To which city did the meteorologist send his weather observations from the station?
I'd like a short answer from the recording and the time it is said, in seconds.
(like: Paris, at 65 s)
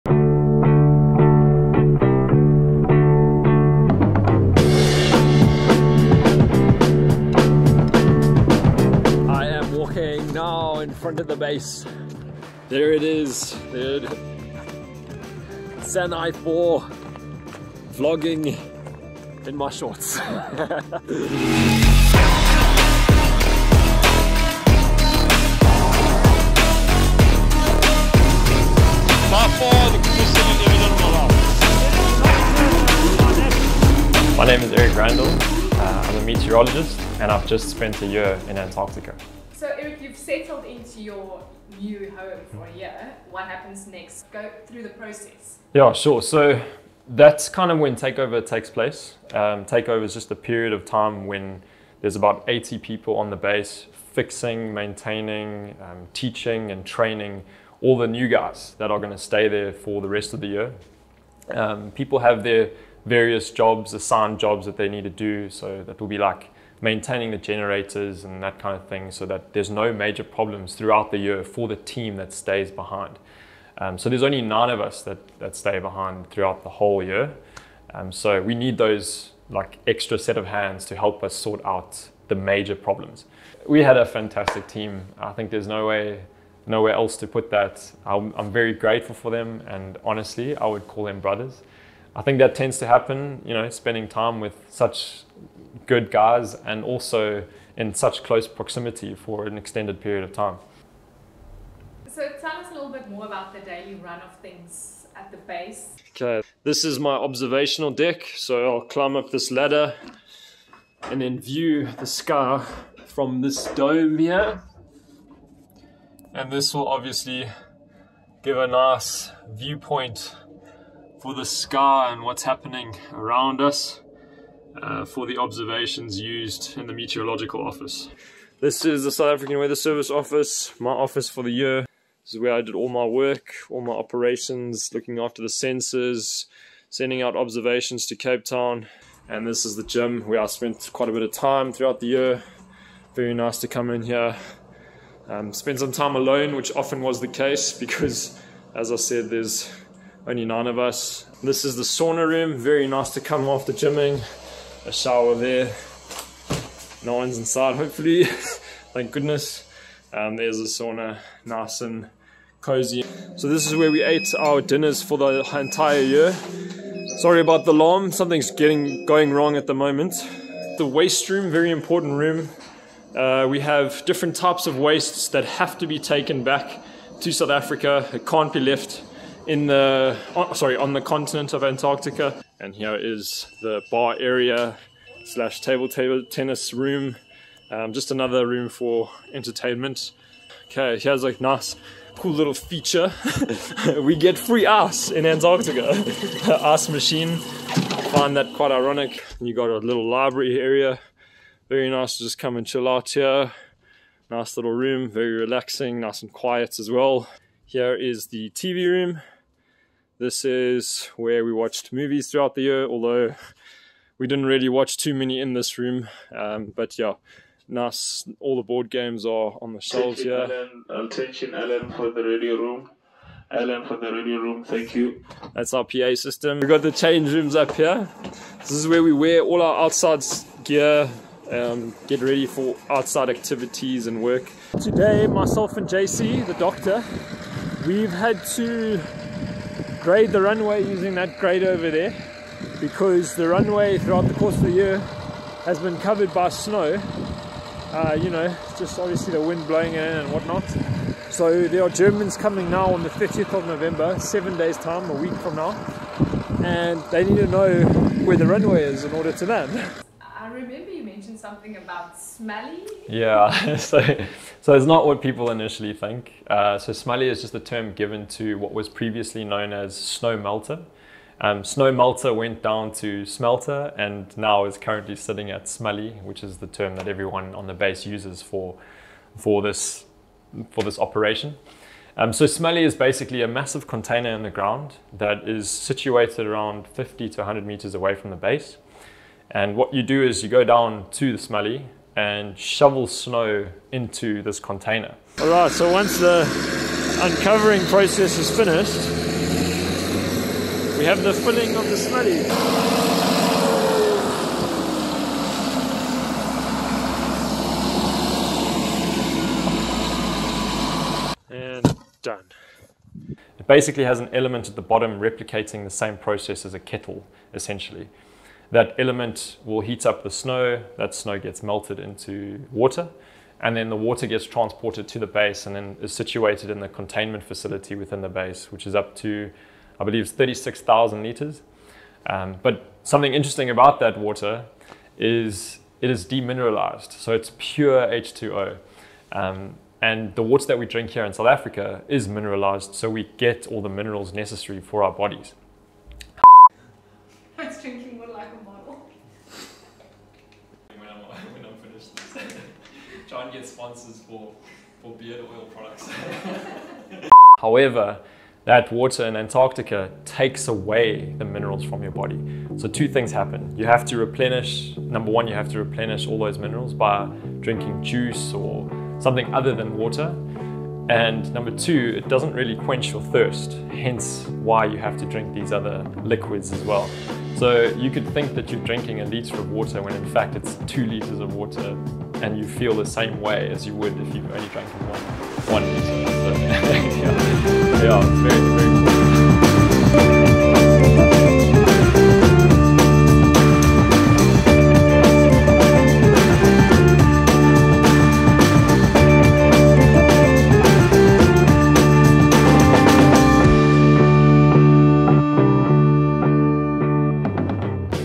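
Cape Town, at 138 s.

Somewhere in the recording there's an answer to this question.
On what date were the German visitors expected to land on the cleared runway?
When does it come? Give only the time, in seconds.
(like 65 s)
253 s.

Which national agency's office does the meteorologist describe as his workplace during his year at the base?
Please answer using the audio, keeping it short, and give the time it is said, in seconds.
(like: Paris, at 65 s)
South African Weather Service, at 129 s.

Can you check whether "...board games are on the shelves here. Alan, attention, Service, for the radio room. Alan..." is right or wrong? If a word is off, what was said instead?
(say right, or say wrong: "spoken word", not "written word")
wrong: "Alan", not "Service".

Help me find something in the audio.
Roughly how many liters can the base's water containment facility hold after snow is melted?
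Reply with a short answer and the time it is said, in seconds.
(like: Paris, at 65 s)
36,000 liters, at 330 s.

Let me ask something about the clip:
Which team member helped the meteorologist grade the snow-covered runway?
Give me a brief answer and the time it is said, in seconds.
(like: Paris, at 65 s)
JC, at 235 s.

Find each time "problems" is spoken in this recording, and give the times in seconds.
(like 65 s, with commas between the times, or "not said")
70 s, 82 s.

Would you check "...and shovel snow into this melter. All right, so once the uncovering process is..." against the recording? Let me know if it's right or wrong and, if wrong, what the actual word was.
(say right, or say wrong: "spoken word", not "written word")
wrong: "container", not "melter".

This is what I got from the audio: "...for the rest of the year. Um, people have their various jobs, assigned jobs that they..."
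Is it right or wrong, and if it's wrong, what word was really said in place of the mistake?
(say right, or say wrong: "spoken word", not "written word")
right.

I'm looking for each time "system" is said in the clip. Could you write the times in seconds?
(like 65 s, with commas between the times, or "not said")
226 s.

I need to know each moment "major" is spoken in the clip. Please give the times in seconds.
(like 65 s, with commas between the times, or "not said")
69 s, 82 s.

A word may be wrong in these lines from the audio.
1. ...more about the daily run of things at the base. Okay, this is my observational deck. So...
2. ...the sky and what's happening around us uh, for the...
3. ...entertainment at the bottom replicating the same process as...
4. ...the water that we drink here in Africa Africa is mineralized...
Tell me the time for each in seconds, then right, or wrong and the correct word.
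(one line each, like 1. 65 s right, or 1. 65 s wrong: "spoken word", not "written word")
1. 103 s right
2. 121 s right
3. 314 s wrong: "element", not "entertainment"
4. 340 s wrong: "South", not "Africa".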